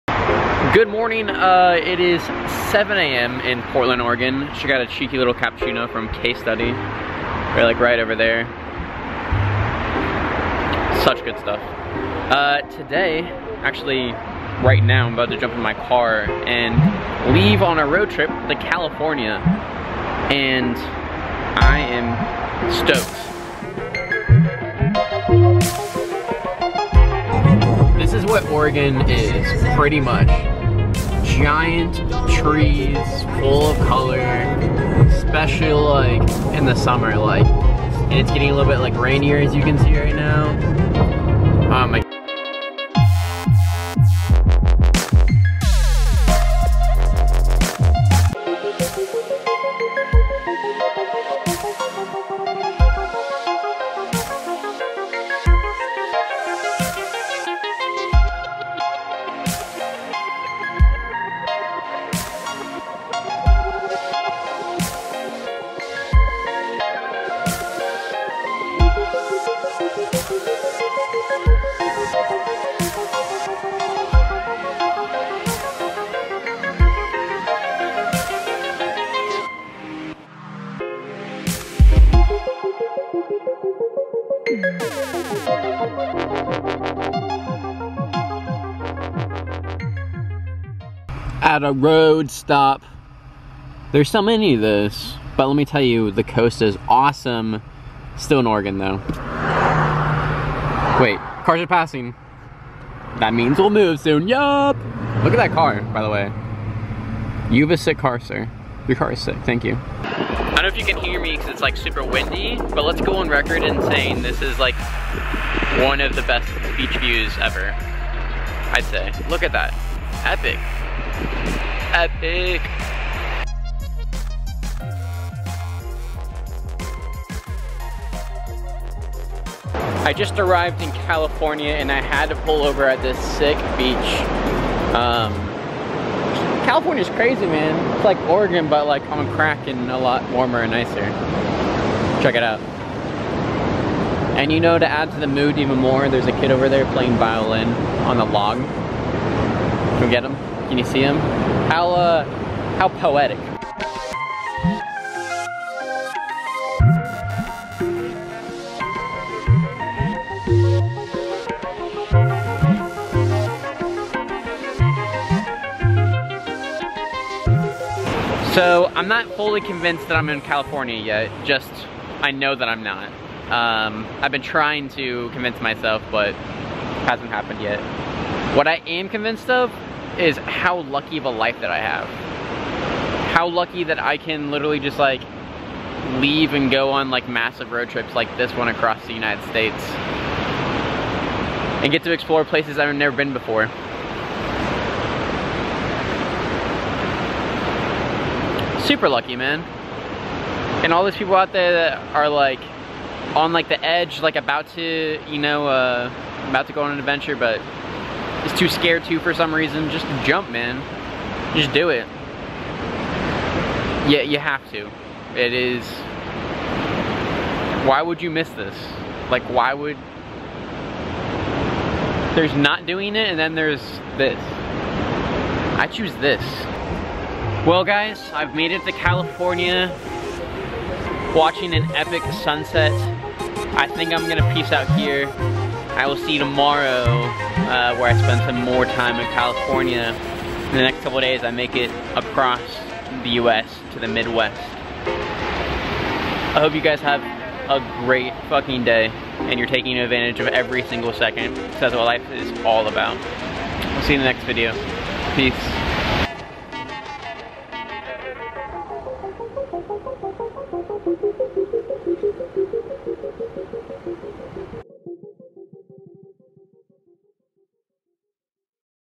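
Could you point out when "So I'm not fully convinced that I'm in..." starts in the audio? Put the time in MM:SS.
02:48.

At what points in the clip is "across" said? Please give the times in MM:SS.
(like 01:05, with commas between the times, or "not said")
03:08, 04:02.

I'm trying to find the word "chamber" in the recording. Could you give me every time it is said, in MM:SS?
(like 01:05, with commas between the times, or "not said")
not said.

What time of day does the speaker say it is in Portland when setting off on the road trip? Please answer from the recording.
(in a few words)
7 a.m.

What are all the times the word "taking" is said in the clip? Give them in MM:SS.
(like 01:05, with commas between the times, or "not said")
04:09.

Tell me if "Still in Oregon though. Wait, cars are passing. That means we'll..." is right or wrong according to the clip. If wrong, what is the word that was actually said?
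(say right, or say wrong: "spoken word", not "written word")
right.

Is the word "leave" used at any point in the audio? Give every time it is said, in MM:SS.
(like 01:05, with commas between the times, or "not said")
00:17, 03:06.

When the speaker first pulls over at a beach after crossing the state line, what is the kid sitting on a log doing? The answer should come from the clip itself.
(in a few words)
playing violin.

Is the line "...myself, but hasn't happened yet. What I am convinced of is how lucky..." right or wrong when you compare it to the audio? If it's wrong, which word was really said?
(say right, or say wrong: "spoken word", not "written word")
right.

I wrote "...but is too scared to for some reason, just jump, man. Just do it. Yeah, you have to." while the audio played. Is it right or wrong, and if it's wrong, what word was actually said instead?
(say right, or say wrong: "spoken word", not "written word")
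right.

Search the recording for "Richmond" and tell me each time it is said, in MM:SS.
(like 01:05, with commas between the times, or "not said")
not said.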